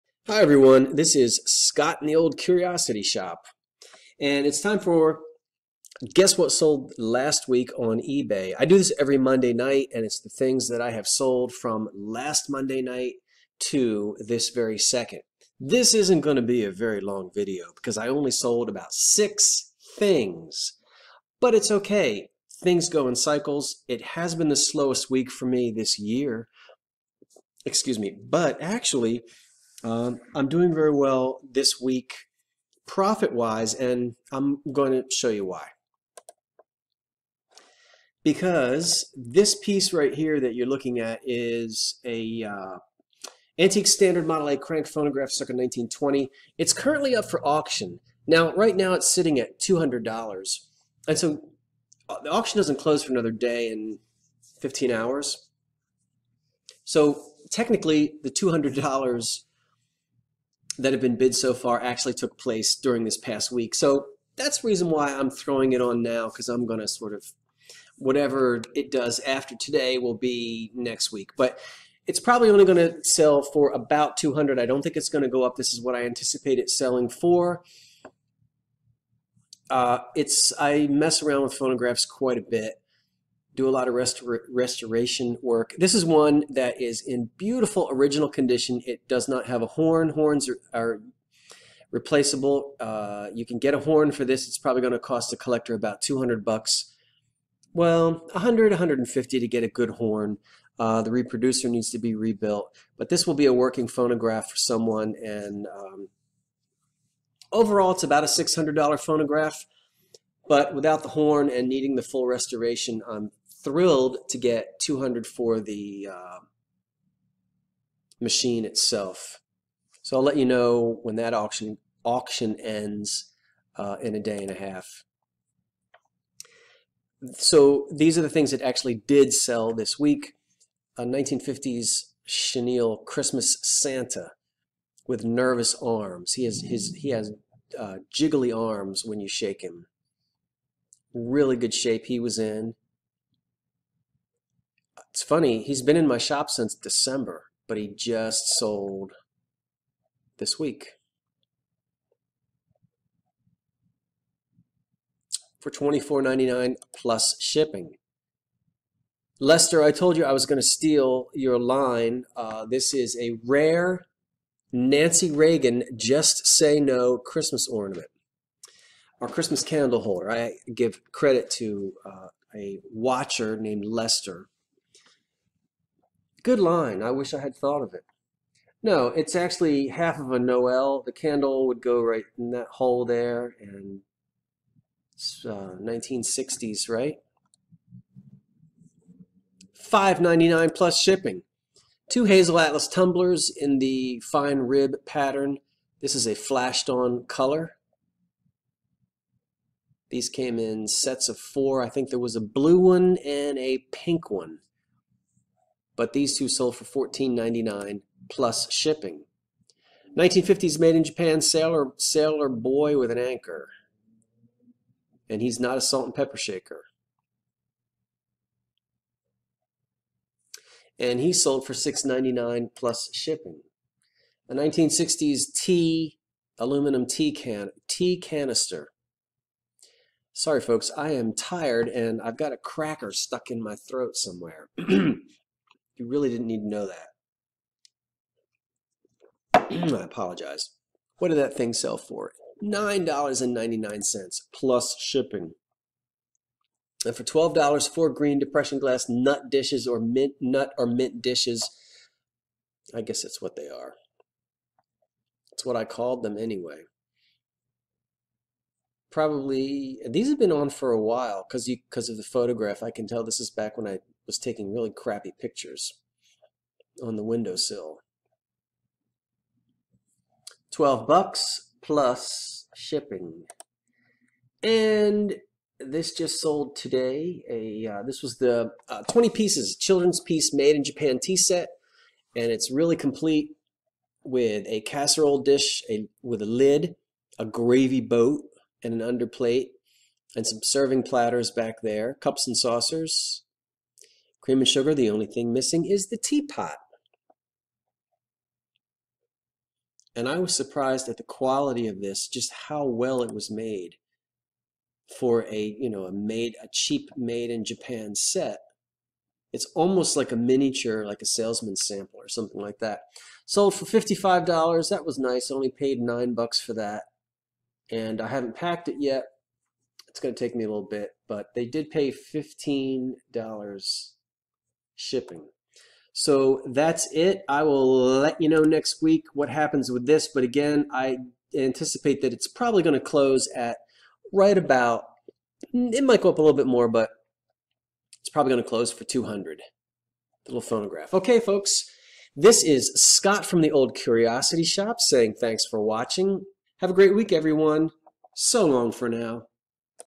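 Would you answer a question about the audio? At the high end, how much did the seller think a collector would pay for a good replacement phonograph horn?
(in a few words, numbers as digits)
150.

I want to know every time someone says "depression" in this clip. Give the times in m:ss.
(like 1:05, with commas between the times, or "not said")
4:08.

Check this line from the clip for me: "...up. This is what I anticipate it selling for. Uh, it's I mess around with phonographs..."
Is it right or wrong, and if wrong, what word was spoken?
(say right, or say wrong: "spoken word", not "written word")
right.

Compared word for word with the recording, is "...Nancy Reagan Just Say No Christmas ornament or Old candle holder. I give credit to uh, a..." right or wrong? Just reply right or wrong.
wrong.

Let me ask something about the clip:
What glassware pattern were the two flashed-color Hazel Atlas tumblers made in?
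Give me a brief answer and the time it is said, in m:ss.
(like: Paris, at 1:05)
fine rib, at 3:14.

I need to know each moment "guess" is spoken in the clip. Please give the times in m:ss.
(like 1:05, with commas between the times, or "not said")
0:06, 4:13.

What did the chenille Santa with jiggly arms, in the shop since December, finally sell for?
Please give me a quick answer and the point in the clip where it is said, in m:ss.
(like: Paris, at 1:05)
$24.99, at 2:35.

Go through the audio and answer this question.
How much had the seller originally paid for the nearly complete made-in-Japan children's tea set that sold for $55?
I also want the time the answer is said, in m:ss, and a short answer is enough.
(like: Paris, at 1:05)
9 dollars, at 5:15.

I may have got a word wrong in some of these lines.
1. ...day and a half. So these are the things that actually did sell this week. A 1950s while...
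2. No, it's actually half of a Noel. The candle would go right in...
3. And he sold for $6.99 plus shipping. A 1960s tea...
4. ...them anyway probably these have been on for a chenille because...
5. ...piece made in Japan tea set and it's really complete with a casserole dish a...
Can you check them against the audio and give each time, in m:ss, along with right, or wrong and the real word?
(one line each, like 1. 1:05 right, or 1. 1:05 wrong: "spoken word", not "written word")
1. 2:04 wrong: "chenille", not "while"
2. 2:58 right
3. 3:40 right
4. 4:16 wrong: "while", not "chenille"
5. 4:40 right.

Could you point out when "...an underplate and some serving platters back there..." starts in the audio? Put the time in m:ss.
4:48.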